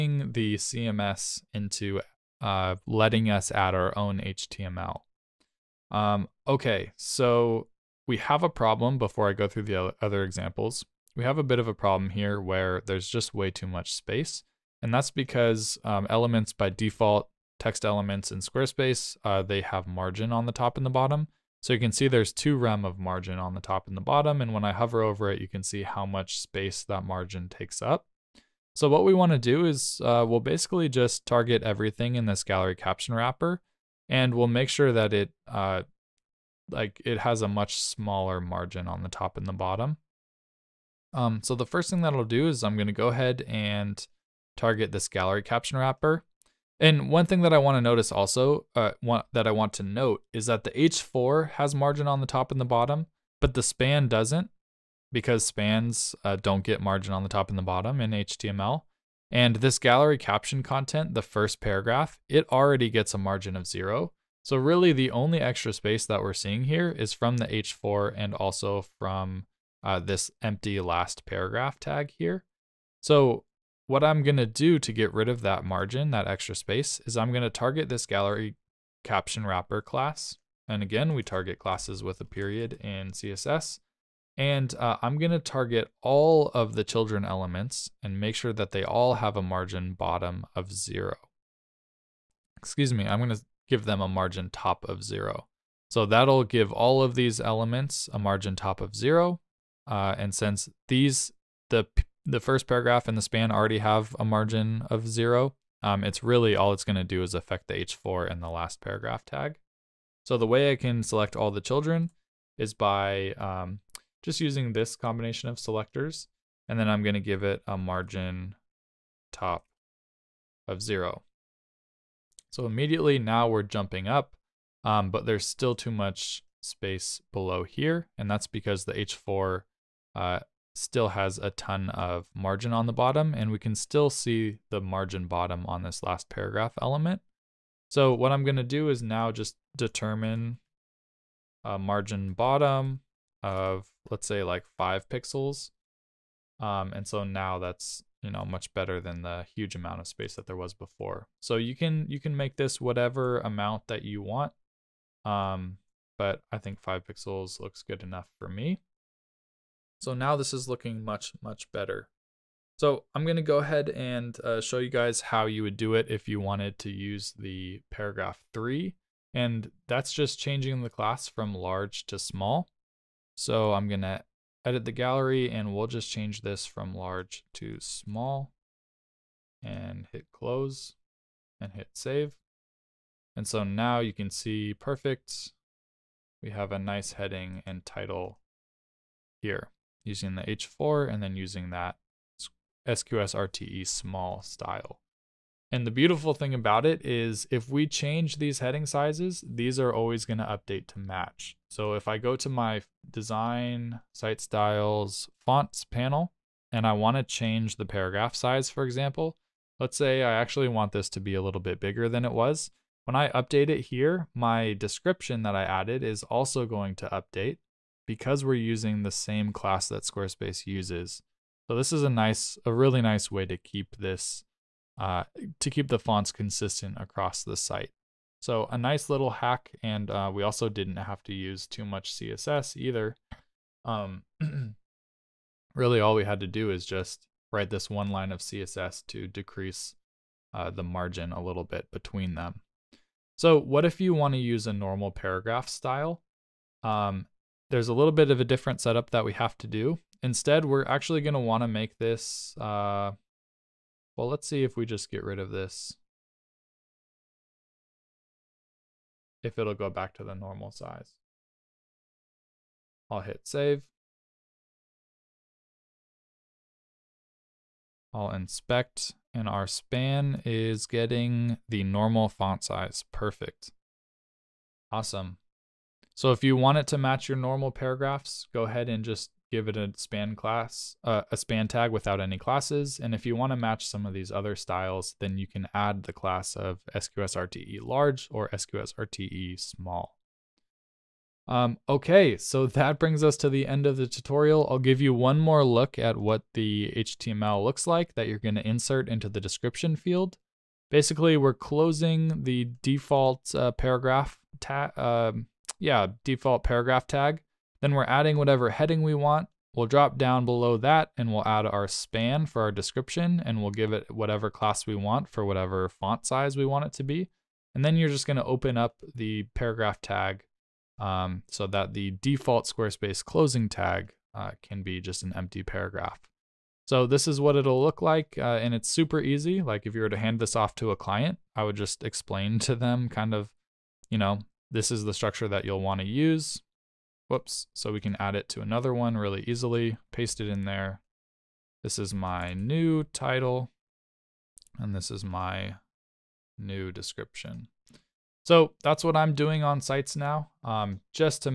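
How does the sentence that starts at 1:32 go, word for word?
Excuse me, I'm going to give them a margin top of zero.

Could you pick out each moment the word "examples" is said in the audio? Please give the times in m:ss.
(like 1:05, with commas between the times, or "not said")
0:10, 3:28.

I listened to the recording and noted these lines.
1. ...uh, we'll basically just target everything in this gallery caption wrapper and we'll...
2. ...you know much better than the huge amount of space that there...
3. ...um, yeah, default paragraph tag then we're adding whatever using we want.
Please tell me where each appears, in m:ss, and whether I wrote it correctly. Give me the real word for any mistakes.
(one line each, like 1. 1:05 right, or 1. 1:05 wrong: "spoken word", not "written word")
1. 0:30 right
2. 2:28 right
3. 5:05 wrong: "heading", not "using".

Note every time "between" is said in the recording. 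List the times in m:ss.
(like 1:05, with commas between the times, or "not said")
4:01.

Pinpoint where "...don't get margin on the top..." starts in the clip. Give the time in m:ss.
0:56.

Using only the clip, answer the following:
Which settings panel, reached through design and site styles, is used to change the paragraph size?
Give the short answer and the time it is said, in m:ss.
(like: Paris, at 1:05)
Fonts panel, at 3:25.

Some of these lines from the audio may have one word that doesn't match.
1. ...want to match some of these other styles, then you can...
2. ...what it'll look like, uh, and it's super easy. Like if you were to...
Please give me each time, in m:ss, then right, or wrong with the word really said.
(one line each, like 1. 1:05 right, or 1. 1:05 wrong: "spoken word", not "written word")
1. 4:43 right
2. 5:27 right.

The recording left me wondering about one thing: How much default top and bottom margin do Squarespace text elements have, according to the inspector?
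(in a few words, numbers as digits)
2 rem.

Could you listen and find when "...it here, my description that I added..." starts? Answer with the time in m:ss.
3:33.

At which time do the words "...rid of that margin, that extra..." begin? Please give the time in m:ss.
1:15.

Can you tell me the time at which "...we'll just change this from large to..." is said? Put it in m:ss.
2:55.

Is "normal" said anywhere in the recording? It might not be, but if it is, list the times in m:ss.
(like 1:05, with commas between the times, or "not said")
4:04, 4:20, 4:31, 4:37.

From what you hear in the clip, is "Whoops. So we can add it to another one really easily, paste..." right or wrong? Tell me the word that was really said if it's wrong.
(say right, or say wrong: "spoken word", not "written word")
right.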